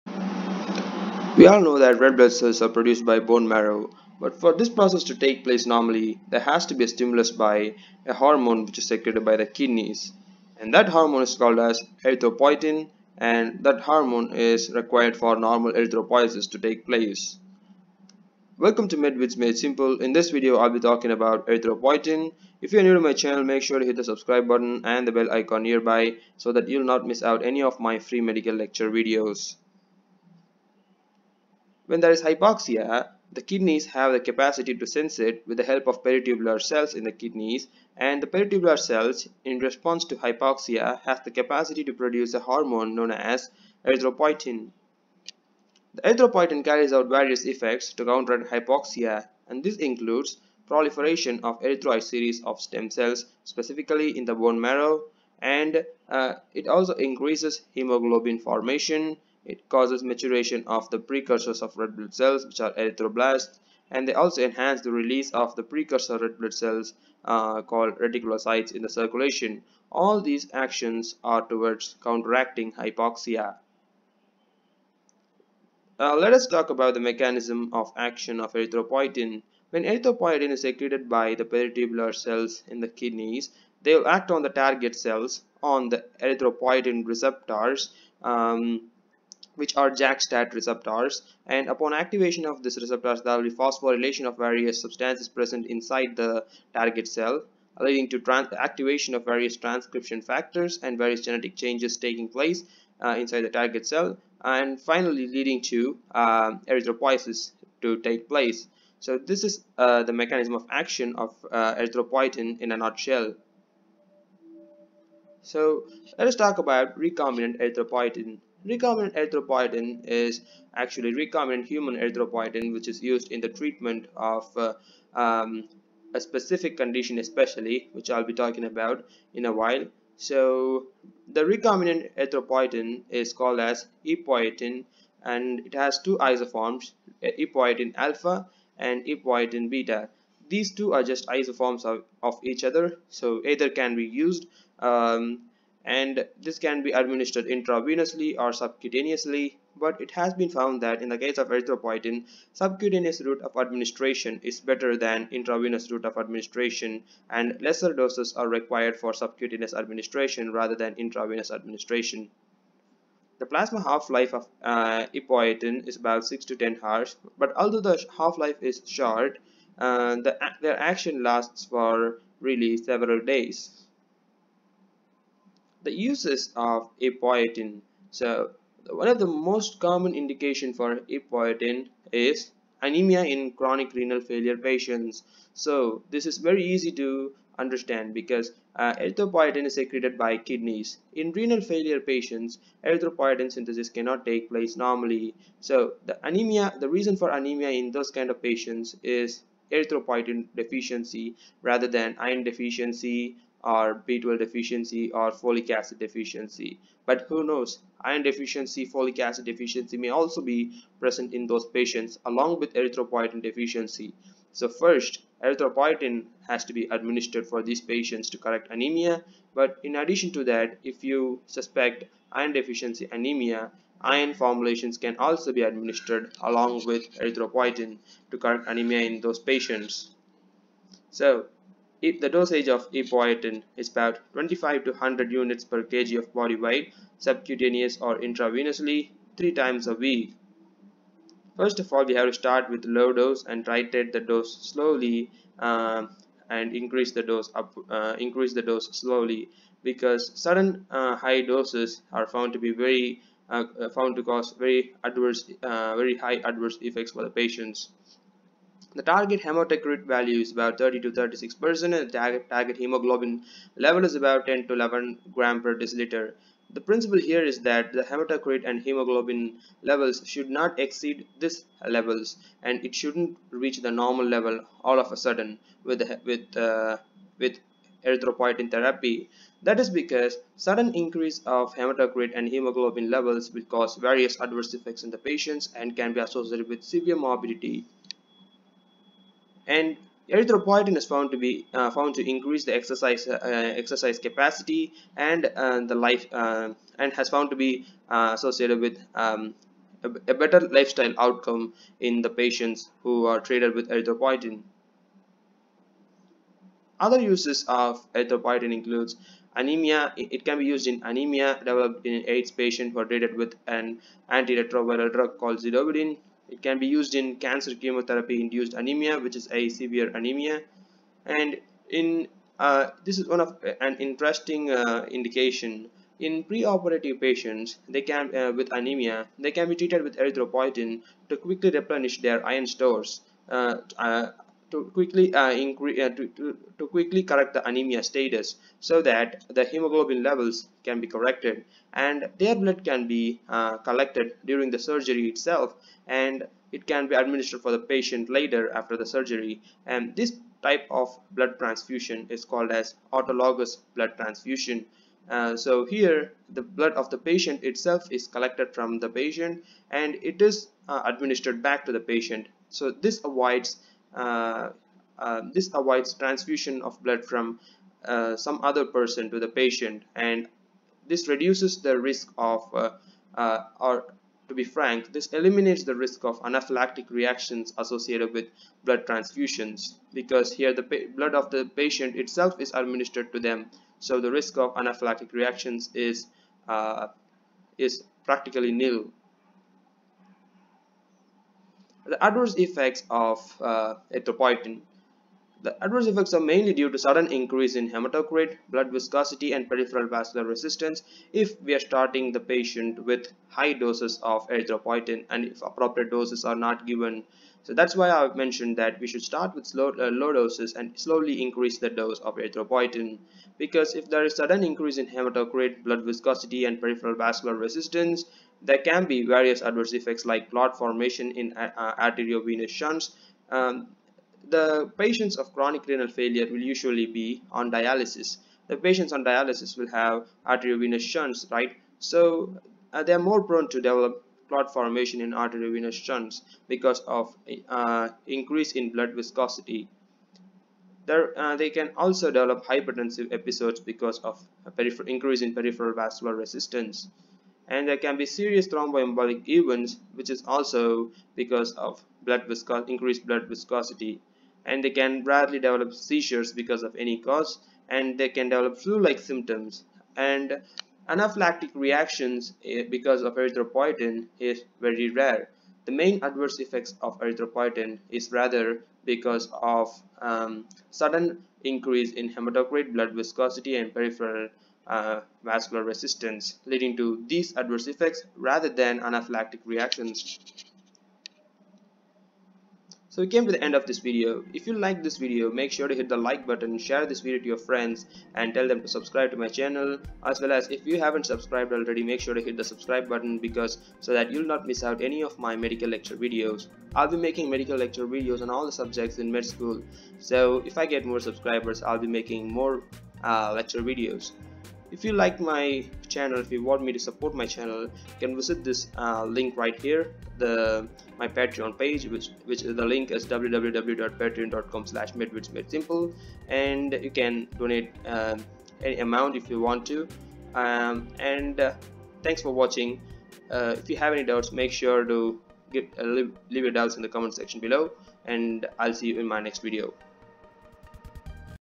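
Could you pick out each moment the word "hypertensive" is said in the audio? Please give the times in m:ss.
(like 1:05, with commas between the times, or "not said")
7:22.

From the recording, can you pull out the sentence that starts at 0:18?
Welcome to Med Vids Made Simple.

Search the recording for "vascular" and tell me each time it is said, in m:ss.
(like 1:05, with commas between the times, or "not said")
6:40, 6:57, 7:25, 7:55.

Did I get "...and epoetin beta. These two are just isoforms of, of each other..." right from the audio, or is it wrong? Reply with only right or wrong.
right.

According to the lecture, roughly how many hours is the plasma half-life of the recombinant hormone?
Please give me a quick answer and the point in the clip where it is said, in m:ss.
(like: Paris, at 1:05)
6 to 10 hours, at 2:46.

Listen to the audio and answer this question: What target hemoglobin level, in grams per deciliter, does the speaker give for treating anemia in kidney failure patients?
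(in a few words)
10 to 11 g/dL.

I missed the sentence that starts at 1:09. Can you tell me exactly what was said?
All these actions are towards counteracting hypoxia.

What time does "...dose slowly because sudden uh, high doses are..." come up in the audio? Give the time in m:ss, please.
4:08.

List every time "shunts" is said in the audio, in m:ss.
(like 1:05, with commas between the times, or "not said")
7:02, 7:10, 7:15.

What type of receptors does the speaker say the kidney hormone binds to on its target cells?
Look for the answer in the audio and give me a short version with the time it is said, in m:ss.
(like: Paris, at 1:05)
JAK-STAT receptors, at 1:29.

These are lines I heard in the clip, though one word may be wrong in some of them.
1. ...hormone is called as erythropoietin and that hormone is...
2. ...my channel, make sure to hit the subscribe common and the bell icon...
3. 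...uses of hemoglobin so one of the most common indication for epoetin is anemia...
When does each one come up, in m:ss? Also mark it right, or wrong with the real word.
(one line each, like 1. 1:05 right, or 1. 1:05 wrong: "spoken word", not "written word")
1. 0:10 right
2. 0:22 wrong: "button", not "common"
3. 2:55 wrong: "epoetin", not "hemoglobin".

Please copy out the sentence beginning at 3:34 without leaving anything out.
So first, erythropoietin has to be administered for these patients to correct anemia.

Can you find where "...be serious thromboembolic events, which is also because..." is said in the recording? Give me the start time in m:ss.
7:28.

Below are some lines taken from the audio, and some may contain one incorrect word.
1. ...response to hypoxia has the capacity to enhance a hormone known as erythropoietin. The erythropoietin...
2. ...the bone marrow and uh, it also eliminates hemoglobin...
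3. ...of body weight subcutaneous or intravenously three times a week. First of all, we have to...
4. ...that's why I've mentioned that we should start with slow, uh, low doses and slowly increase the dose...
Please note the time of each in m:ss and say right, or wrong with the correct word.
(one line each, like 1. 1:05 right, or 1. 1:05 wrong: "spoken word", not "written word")
1. 0:39 wrong: "produce", not "enhance"
2. 0:54 wrong: "increases", not "eliminates"
3. 3:56 right
4. 6:47 right.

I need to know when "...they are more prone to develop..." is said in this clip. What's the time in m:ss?
7:13.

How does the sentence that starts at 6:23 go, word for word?
So the risk of anaphylactic reactions is, uh, is practically nil.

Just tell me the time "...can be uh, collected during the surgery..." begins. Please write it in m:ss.
5:42.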